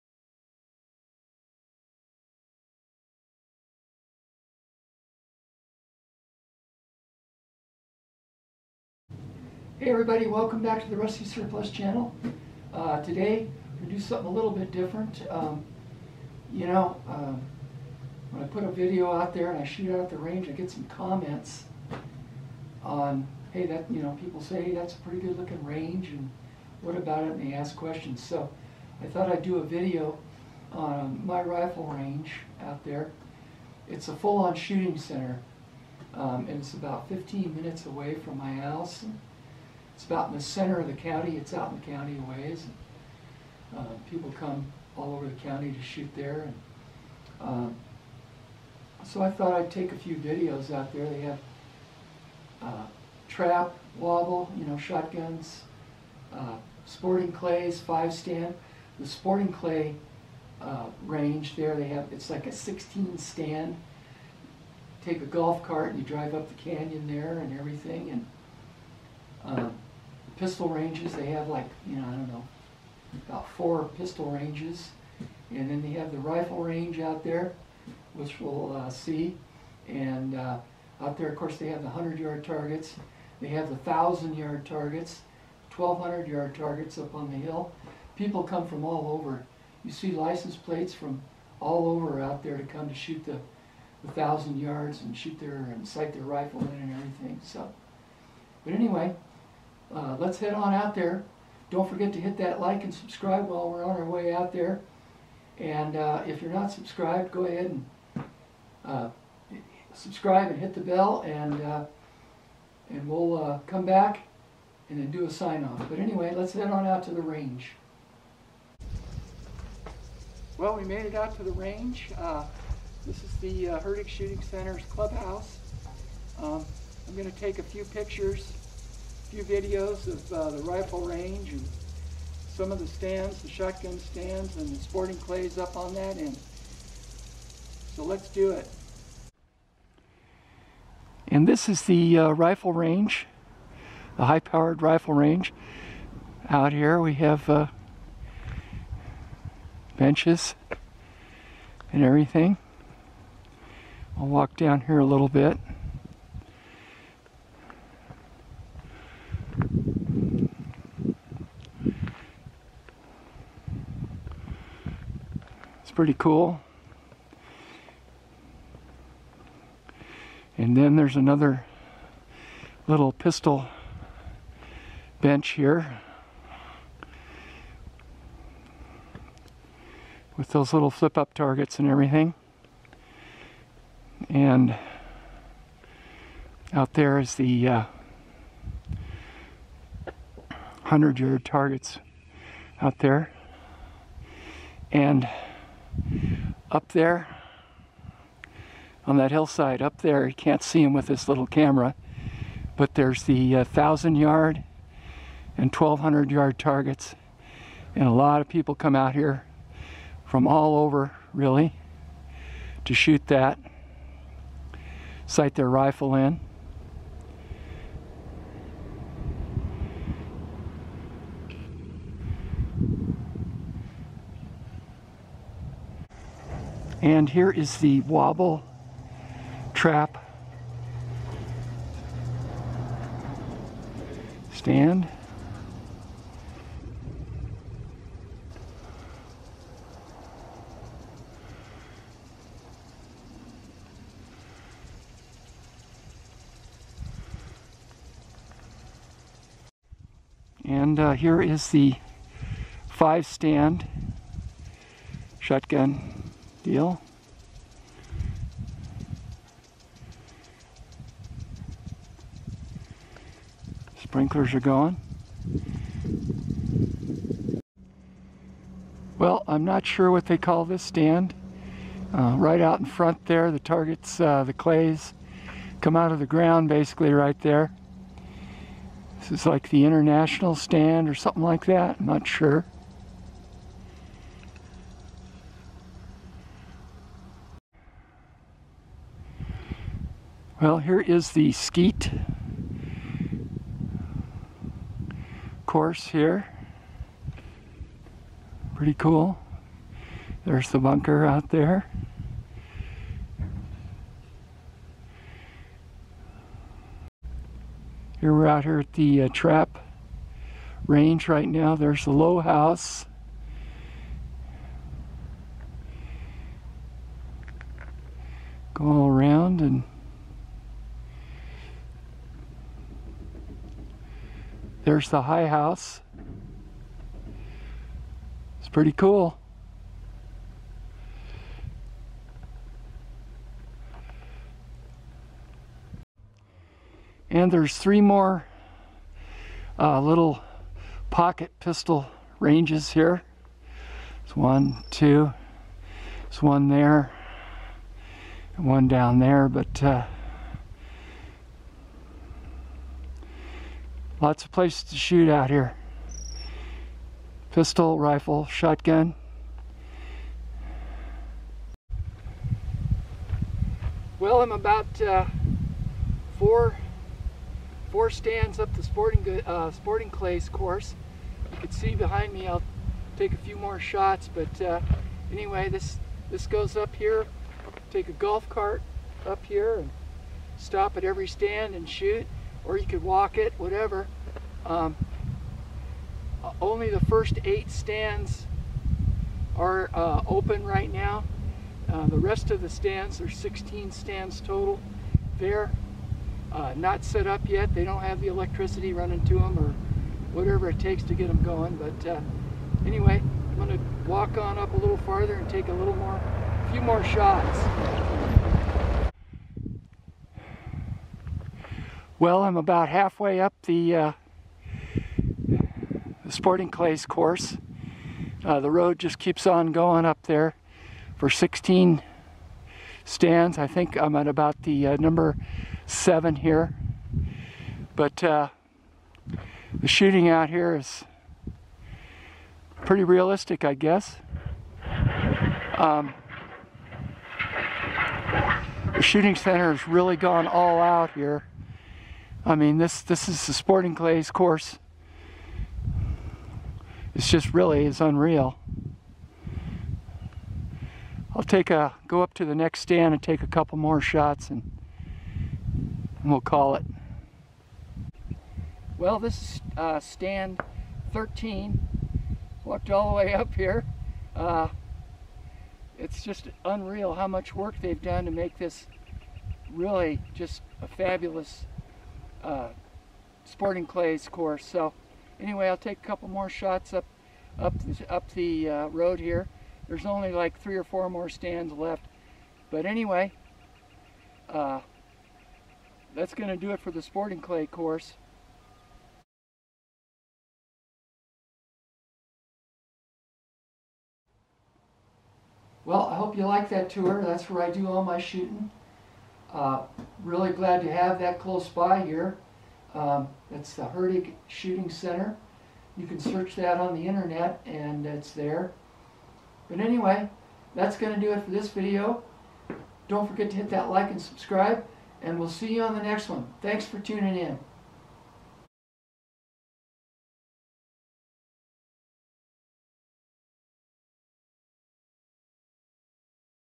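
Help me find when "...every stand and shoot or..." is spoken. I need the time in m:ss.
6:21.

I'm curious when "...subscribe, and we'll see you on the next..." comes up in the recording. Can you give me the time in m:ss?
8:34.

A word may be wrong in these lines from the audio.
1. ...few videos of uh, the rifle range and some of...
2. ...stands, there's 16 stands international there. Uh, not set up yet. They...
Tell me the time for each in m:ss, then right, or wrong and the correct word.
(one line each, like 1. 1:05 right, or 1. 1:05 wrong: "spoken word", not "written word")
1. 2:09 right
2. 6:32 wrong: "total", not "international".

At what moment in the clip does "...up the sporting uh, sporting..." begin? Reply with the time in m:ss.
6:08.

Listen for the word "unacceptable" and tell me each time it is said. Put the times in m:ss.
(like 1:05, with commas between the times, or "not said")
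not said.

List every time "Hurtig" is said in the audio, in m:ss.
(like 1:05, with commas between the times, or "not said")
2:03, 8:23.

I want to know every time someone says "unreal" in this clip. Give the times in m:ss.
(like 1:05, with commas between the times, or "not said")
7:28, 7:46.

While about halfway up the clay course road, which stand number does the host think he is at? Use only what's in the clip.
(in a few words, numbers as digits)
7.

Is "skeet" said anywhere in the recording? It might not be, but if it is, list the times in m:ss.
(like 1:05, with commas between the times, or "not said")
4:51.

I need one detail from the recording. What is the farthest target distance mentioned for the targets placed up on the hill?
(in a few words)
1,200 yards.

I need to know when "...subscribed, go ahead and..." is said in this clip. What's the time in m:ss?
1:46.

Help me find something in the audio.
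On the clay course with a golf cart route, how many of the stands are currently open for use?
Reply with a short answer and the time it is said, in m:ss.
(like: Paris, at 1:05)
8, at 6:27.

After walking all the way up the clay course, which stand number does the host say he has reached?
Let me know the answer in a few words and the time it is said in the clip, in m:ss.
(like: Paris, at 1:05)
13, at 7:39.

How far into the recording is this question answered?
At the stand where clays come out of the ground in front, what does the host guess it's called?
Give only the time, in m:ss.
4:39.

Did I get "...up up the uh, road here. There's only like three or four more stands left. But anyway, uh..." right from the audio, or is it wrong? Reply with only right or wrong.
right.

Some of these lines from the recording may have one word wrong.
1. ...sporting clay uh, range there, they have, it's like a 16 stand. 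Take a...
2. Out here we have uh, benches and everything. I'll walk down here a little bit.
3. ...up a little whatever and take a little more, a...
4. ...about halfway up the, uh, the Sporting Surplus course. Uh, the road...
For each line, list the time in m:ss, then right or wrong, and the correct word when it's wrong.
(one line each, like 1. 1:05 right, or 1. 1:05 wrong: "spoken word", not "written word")
1. 0:59 right
2. 2:26 right
3. 6:44 wrong: "farther", not "whatever"
4. 6:52 wrong: "Clays", not "Surplus".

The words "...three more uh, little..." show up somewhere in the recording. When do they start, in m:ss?
5:37.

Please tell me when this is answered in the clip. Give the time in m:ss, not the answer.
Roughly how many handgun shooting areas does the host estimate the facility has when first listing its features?
1:13.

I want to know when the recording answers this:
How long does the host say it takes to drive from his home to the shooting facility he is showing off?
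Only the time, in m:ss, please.
0:37.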